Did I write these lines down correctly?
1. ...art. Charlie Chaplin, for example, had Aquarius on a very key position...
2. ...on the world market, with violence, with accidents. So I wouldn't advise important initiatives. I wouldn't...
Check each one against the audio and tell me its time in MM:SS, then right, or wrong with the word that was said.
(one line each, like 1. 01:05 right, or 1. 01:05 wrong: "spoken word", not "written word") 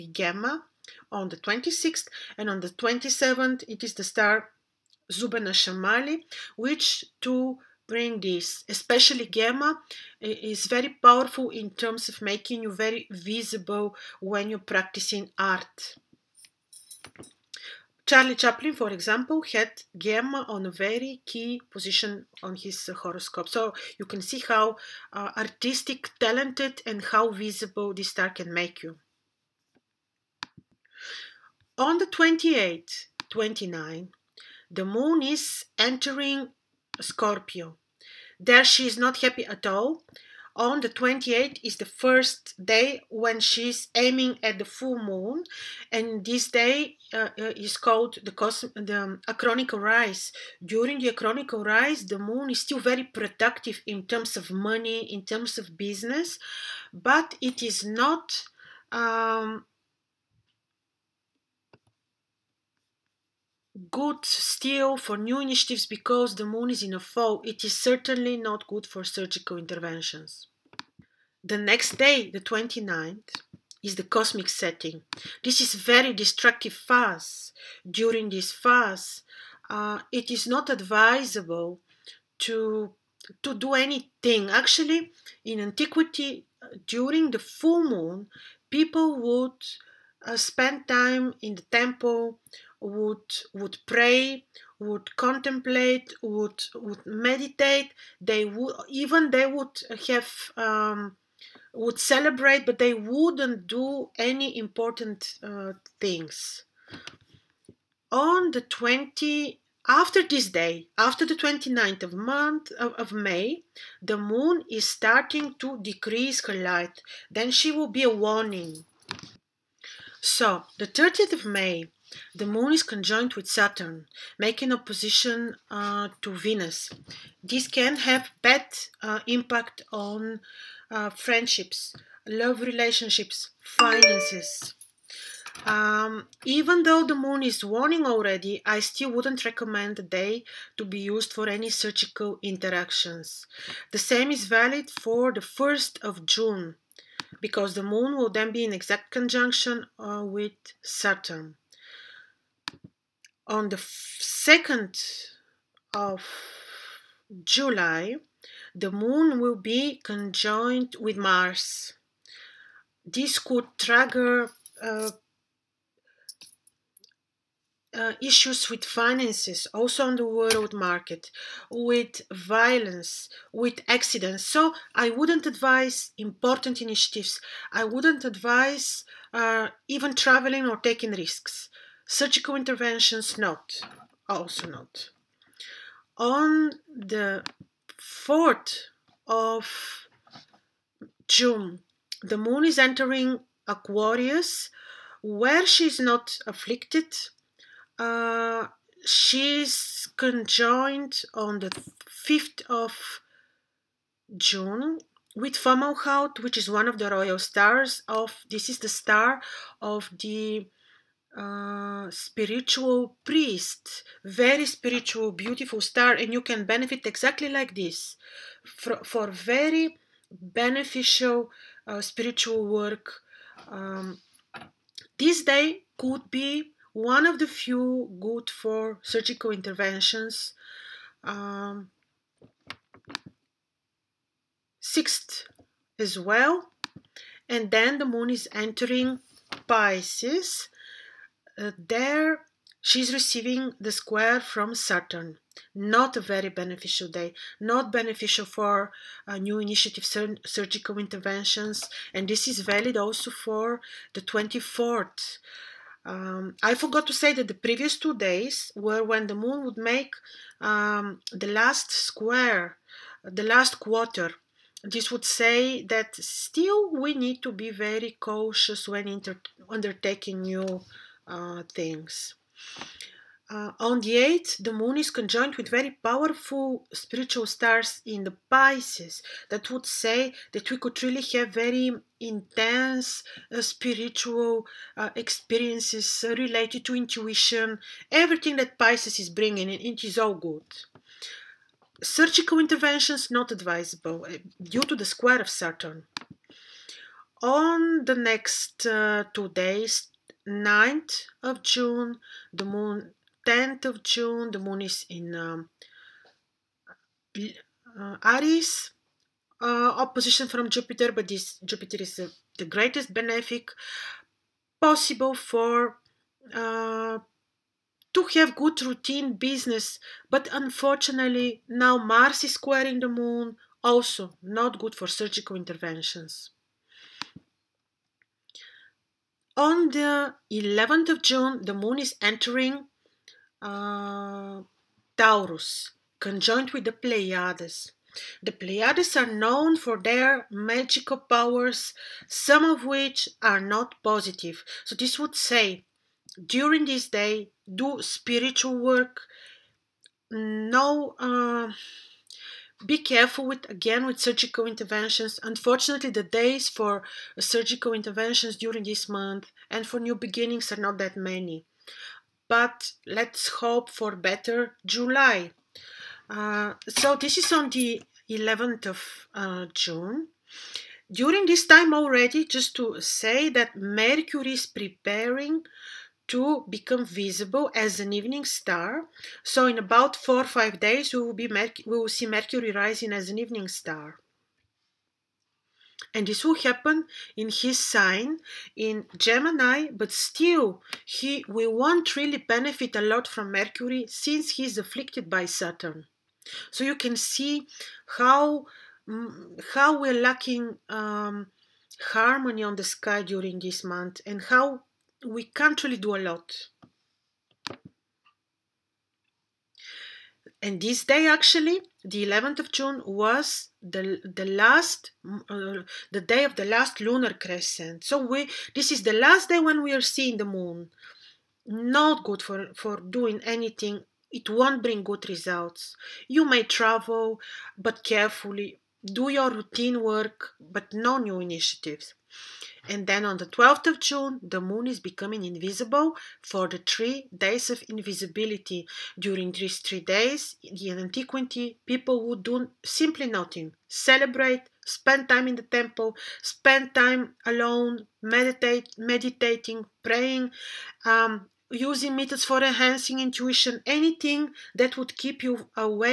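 1. 00:15 wrong: "Gamma", not "Aquarius"
2. 02:50 right.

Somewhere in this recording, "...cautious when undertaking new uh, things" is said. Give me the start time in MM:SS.
04:28.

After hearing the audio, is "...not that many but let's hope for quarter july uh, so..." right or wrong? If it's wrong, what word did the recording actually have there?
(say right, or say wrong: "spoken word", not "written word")
wrong: "better", not "quarter".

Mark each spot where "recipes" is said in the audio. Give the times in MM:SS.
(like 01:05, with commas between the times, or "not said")
not said.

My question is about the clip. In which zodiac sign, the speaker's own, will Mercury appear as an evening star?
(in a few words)
Gemini.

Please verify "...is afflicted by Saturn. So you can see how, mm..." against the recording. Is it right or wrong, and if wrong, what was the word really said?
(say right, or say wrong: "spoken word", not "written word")
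right.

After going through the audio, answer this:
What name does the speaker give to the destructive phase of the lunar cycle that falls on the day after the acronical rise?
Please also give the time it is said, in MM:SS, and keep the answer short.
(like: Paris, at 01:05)
cosmic setting, at 01:14.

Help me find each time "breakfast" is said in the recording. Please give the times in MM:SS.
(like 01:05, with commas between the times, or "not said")
not said.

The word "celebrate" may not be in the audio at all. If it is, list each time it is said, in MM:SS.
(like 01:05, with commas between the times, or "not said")
01:41, 07:23.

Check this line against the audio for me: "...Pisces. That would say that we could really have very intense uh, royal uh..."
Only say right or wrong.
wrong.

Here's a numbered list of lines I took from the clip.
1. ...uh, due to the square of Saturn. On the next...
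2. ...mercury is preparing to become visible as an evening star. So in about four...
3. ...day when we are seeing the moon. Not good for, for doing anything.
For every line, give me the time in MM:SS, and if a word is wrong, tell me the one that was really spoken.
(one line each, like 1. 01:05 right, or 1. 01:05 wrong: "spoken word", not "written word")
1. 04:54 right
2. 06:13 right
3. 06:59 right.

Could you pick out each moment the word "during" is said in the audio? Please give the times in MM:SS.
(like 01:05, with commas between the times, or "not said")
00:50, 01:17, 01:26, 05:46, 05:58, 06:11, 06:43, 07:19.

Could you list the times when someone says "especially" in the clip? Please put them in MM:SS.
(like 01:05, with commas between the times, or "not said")
00:08.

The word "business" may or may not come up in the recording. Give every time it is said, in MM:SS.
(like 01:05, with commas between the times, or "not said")
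00:55, 05:19.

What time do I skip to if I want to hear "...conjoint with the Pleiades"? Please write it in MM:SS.
05:36.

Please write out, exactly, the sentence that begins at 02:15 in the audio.
Um, even though the moon is waning already, I still wouldn't recommend the day to be used for any surgical interactions.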